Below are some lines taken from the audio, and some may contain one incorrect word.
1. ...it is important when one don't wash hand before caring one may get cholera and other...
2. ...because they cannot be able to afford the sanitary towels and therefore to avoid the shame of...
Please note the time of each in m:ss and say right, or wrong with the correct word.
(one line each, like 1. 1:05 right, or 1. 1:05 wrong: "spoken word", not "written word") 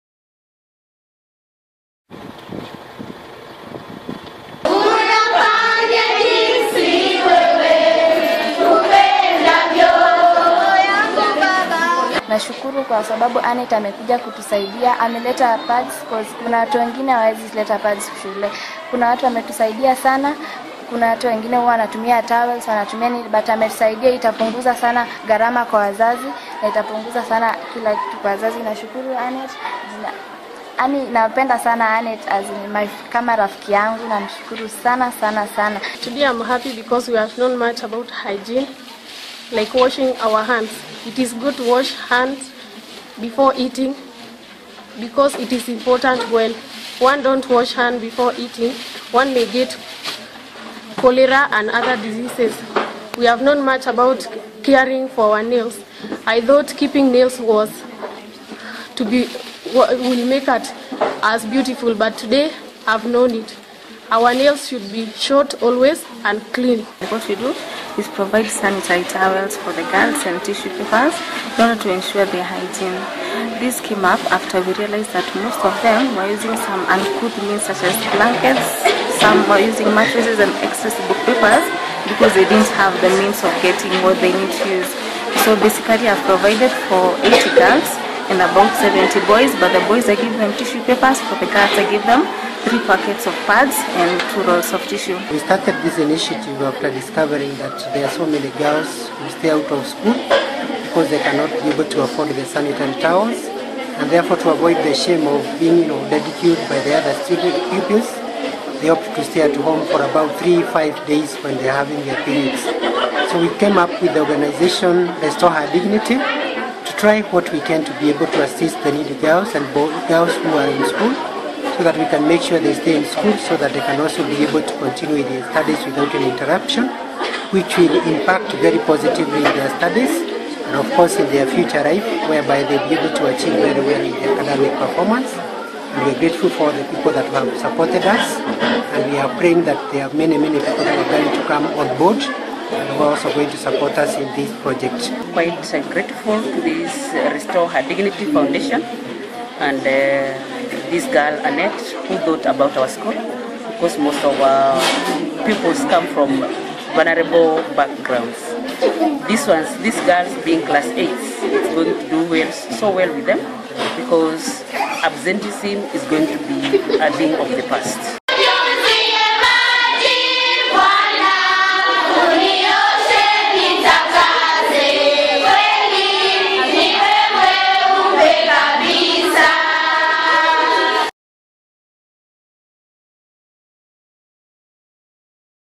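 1. 0:45 wrong: "eating", not "caring"
2. 1:40 right.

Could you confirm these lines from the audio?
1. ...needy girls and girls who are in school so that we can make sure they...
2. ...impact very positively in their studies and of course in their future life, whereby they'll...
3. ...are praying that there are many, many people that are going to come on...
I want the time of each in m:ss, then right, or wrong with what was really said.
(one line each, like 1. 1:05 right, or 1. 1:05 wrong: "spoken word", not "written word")
1. 1:58 right
2. 2:08 right
3. 2:19 right.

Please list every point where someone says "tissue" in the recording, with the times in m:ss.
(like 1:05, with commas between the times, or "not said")
1:10, 1:30, 1:34.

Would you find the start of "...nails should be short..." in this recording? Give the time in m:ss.
1:04.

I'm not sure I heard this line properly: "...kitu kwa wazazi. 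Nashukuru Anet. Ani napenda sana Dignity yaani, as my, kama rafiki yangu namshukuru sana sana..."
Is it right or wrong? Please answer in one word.
wrong.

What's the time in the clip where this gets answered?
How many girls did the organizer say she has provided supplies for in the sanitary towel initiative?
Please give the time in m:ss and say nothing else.
1:27.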